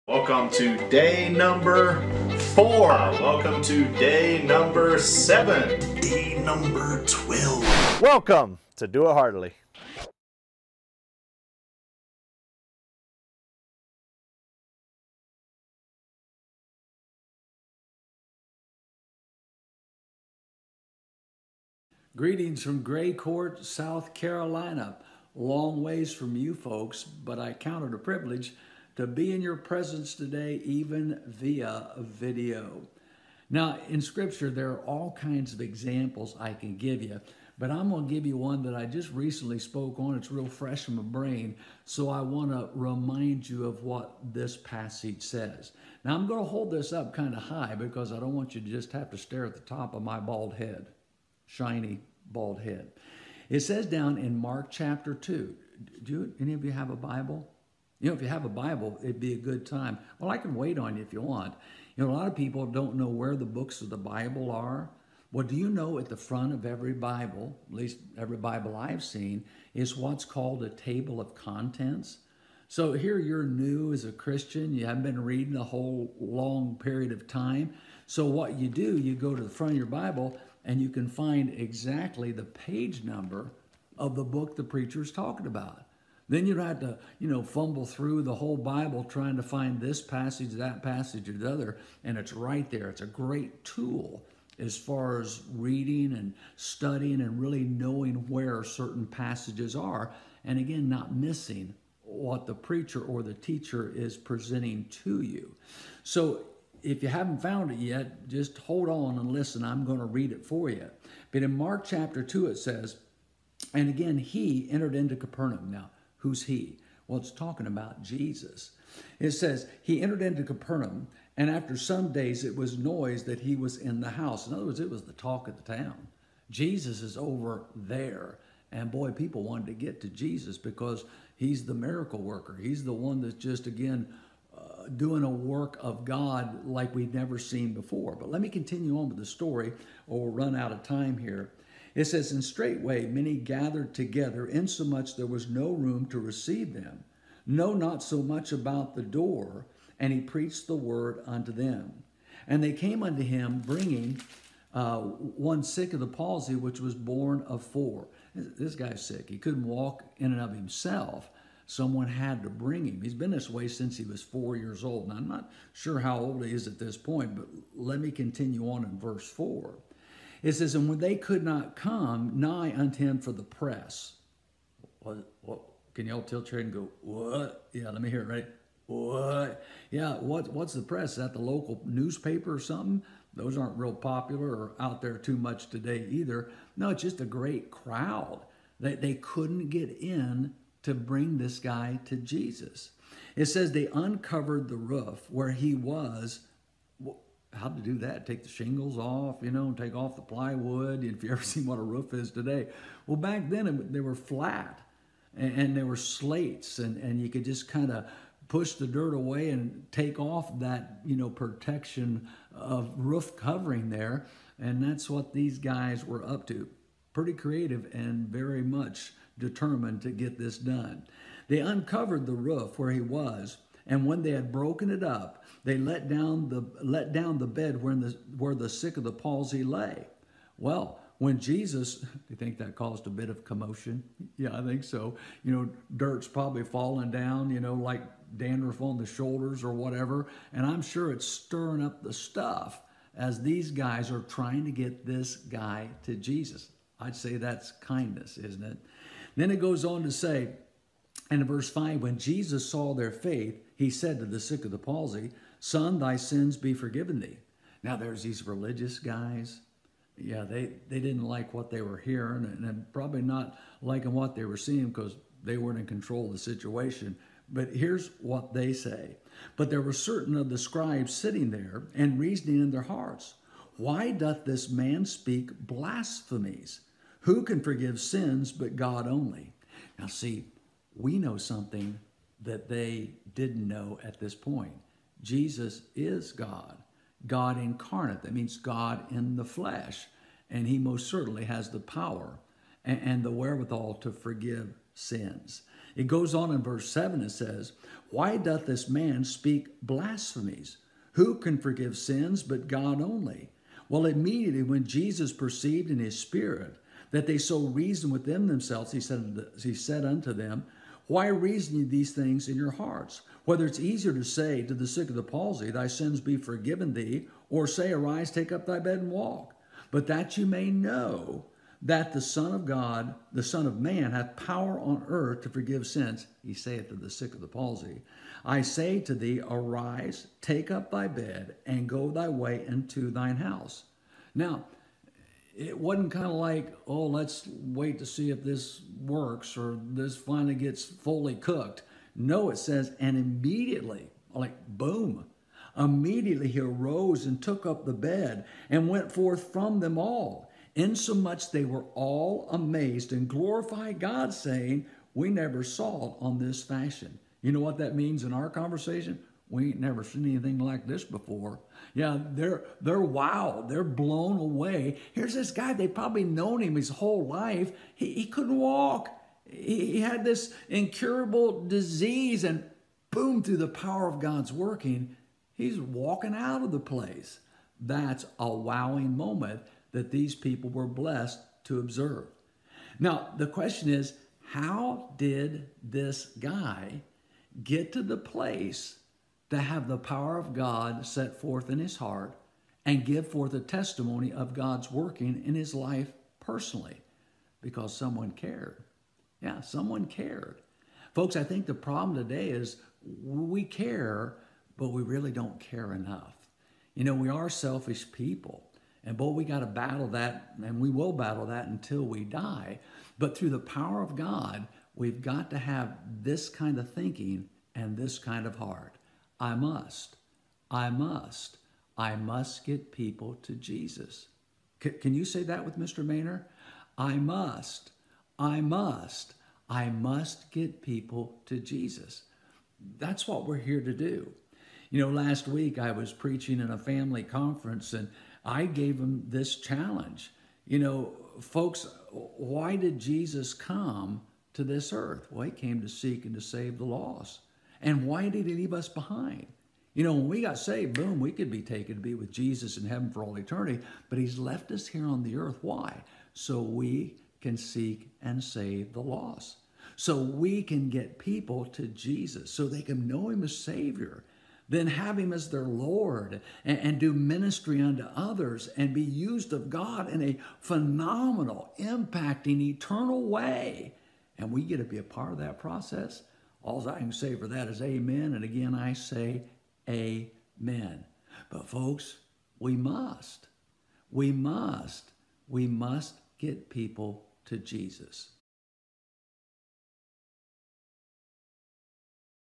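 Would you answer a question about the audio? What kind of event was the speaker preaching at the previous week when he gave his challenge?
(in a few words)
family conference.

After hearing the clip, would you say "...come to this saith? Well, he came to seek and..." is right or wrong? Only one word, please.
wrong.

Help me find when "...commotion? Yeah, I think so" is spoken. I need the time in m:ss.
3:53.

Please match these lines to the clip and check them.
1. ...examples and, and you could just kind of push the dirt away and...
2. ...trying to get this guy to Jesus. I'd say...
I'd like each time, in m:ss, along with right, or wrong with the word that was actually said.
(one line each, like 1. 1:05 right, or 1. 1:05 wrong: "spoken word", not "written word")
1. 3:25 wrong: "slates", not "examples"
2. 4:04 right.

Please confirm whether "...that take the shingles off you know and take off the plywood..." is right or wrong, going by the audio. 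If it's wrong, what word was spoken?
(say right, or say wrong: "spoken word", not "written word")
right.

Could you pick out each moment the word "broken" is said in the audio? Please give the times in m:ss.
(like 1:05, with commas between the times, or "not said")
3:44.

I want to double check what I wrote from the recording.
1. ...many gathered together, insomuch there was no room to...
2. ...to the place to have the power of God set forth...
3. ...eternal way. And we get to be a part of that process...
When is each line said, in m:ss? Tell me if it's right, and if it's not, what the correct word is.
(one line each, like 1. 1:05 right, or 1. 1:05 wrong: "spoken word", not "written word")
1. 2:23 right
2. 6:27 right
3. 7:52 right.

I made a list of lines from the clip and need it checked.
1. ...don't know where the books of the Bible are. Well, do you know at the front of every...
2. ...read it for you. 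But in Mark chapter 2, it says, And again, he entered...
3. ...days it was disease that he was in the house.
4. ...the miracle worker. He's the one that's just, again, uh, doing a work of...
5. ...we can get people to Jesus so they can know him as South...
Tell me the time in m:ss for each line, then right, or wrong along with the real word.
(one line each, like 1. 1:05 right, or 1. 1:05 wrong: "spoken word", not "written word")
1. 1:02 right
2. 1:50 right
3. 2:02 wrong: "noise", not "disease"
4. 2:11 right
5. 7:40 wrong: "Savior", not "South".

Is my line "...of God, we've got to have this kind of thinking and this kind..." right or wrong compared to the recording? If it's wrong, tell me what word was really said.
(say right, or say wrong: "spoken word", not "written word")
right.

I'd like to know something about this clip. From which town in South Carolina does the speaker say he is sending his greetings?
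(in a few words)
Gray Court.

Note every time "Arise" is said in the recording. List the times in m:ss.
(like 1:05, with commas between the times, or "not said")
5:17, 5:29.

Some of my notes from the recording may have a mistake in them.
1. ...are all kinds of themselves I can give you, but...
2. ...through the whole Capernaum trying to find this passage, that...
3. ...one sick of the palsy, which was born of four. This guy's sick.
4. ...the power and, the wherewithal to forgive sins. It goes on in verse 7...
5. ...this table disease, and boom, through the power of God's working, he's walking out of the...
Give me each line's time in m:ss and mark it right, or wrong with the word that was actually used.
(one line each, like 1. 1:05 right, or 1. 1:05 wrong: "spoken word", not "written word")
1. 0:34 wrong: "examples", not "themselves"
2. 1:27 wrong: "Bible", not "Capernaum"
3. 2:35 right
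4. 4:51 right
5. 6:10 wrong: "incurable", not "table".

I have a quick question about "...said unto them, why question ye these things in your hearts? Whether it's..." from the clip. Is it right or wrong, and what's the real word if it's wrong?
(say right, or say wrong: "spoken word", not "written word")
wrong: "reason", not "question".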